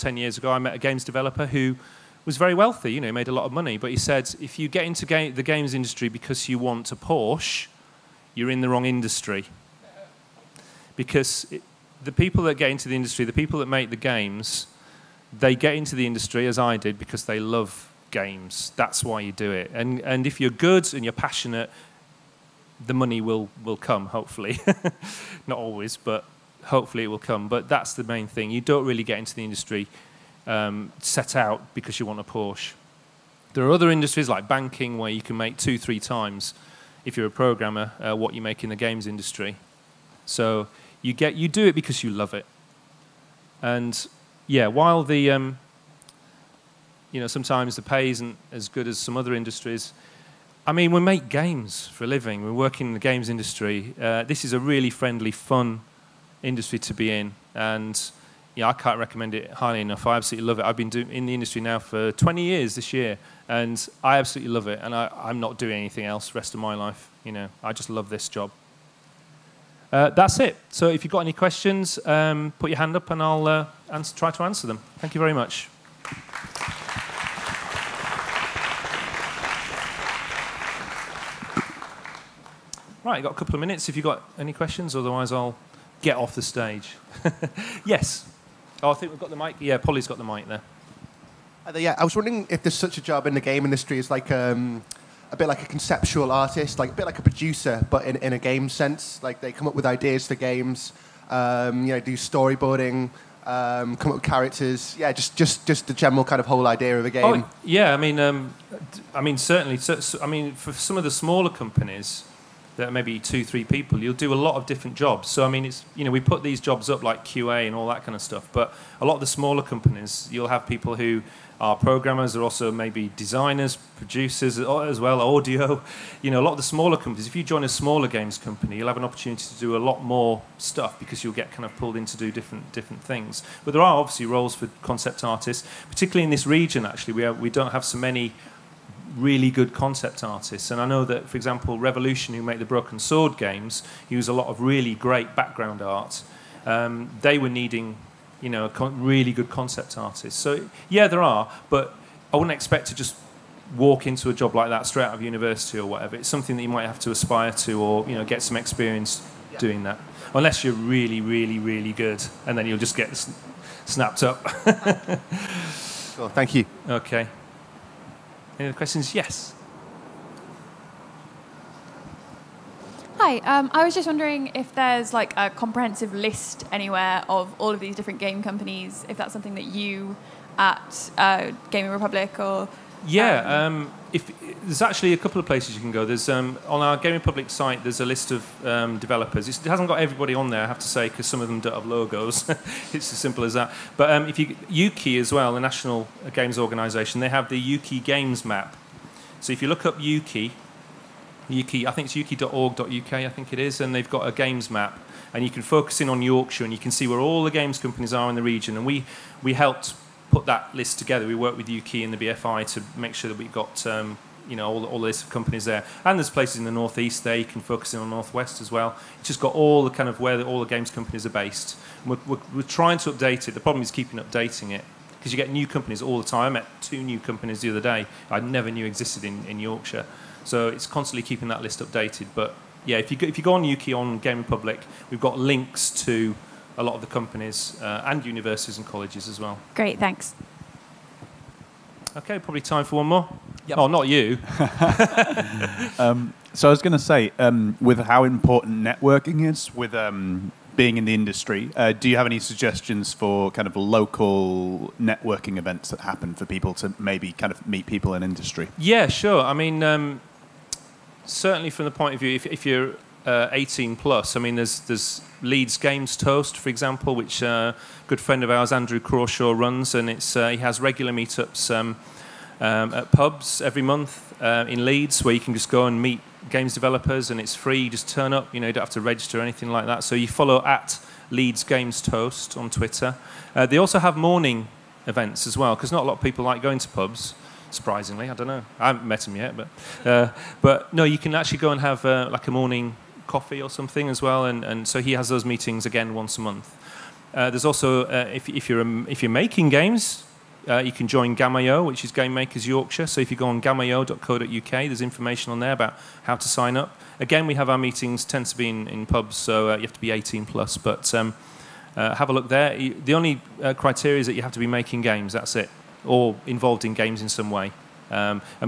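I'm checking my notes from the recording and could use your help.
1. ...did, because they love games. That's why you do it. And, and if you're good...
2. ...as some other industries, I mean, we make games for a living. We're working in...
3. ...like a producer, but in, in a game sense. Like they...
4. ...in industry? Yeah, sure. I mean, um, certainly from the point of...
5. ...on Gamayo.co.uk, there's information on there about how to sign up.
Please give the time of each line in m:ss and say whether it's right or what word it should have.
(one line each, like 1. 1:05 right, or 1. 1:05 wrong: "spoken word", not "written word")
1. 0:16 right
2. 0:48 right
3. 1:37 right
4. 4:18 right
5. 5:03 right.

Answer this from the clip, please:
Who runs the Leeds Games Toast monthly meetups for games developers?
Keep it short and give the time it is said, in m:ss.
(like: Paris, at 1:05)
Andrew Crawshaw, at 4:28.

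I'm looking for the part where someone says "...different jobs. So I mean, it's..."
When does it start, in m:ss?
1:54.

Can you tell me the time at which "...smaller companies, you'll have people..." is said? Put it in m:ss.
1:59.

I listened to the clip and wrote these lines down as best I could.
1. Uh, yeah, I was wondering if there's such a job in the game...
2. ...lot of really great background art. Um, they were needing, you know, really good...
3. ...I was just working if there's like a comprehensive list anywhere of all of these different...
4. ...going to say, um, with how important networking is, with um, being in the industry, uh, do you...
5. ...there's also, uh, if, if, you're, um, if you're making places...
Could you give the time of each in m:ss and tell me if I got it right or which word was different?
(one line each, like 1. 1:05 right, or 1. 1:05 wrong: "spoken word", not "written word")
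1. 1:31 right
2. 2:24 right
3. 2:53 wrong: "wondering", not "working"
4. 4:06 right
5. 4:57 wrong: "games", not "places".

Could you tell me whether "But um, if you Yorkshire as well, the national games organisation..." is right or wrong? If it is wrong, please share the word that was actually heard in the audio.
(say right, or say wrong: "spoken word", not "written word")
wrong: "Ukie", not "Yorkshire".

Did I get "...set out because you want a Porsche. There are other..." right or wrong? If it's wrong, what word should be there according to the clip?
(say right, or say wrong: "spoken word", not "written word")
right.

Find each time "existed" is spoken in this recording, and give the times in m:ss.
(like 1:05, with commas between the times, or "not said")
3:48.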